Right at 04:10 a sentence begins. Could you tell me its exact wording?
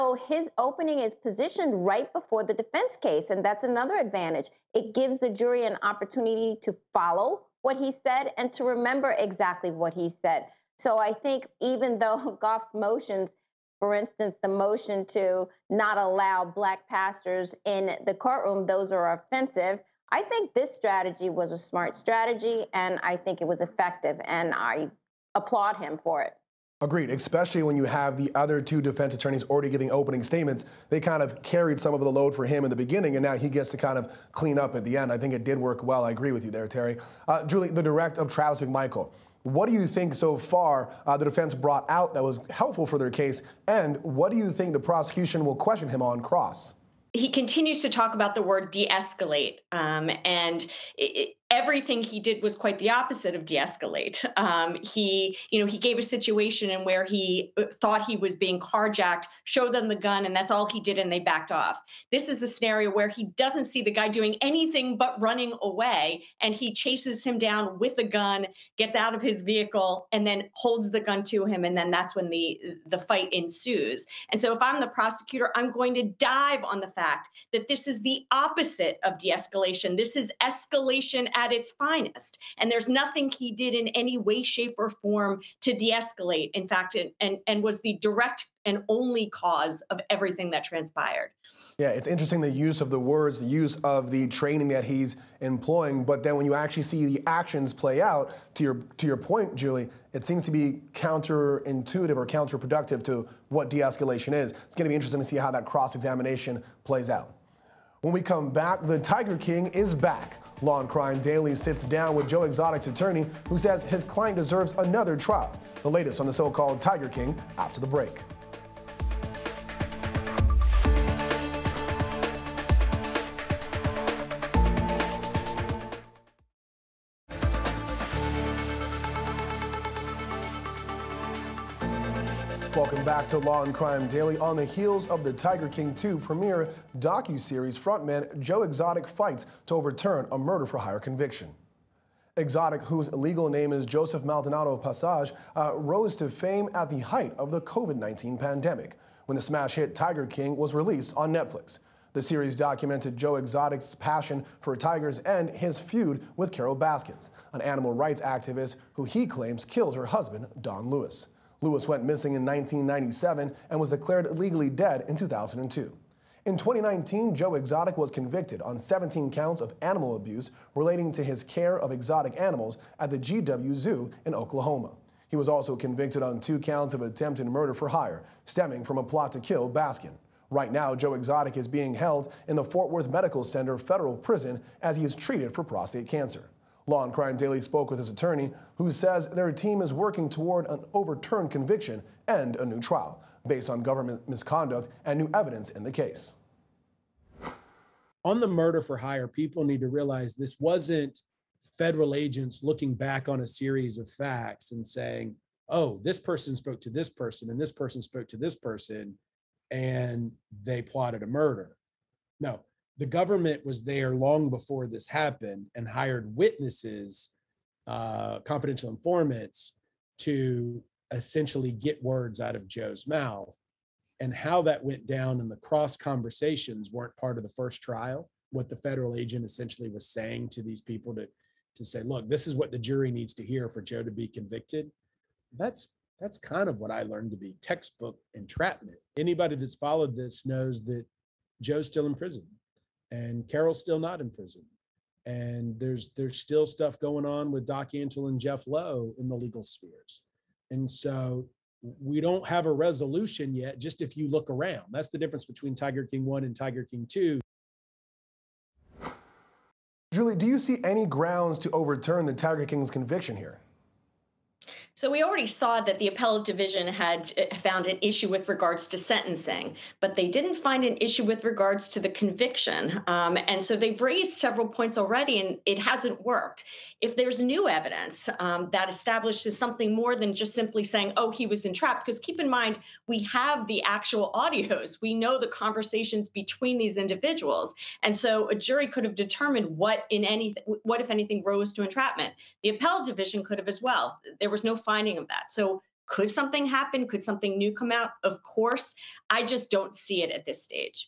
And so we don't have a resolution yet, just if you look around.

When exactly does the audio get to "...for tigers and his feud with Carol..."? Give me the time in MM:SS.
02:34.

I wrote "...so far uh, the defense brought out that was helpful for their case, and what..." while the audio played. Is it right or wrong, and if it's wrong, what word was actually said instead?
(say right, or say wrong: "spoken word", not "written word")
right.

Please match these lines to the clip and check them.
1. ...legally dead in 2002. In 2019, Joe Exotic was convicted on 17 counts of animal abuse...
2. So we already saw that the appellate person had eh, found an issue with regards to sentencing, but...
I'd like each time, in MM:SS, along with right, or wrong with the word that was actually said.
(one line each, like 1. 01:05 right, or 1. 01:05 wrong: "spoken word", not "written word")
1. 02:44 right
2. 04:24 wrong: "division", not "person".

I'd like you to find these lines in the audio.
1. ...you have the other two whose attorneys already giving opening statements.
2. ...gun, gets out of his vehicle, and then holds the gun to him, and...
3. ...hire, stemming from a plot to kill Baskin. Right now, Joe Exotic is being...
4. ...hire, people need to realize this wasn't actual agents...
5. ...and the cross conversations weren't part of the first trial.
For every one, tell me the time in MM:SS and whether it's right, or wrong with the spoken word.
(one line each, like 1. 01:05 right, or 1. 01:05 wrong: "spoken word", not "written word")
1. 00:27 wrong: "defense", not "whose"
2. 01:08 right
3. 02:57 right
4. 03:18 wrong: "federal", not "actual"
5. 03:45 right.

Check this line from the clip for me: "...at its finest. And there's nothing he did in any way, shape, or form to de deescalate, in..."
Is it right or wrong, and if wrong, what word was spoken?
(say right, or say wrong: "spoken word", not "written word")
wrong: "escalate", not "deescalate".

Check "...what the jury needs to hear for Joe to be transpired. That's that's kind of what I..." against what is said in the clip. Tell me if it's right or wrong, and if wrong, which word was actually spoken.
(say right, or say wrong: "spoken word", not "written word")
wrong: "convicted", not "transpired".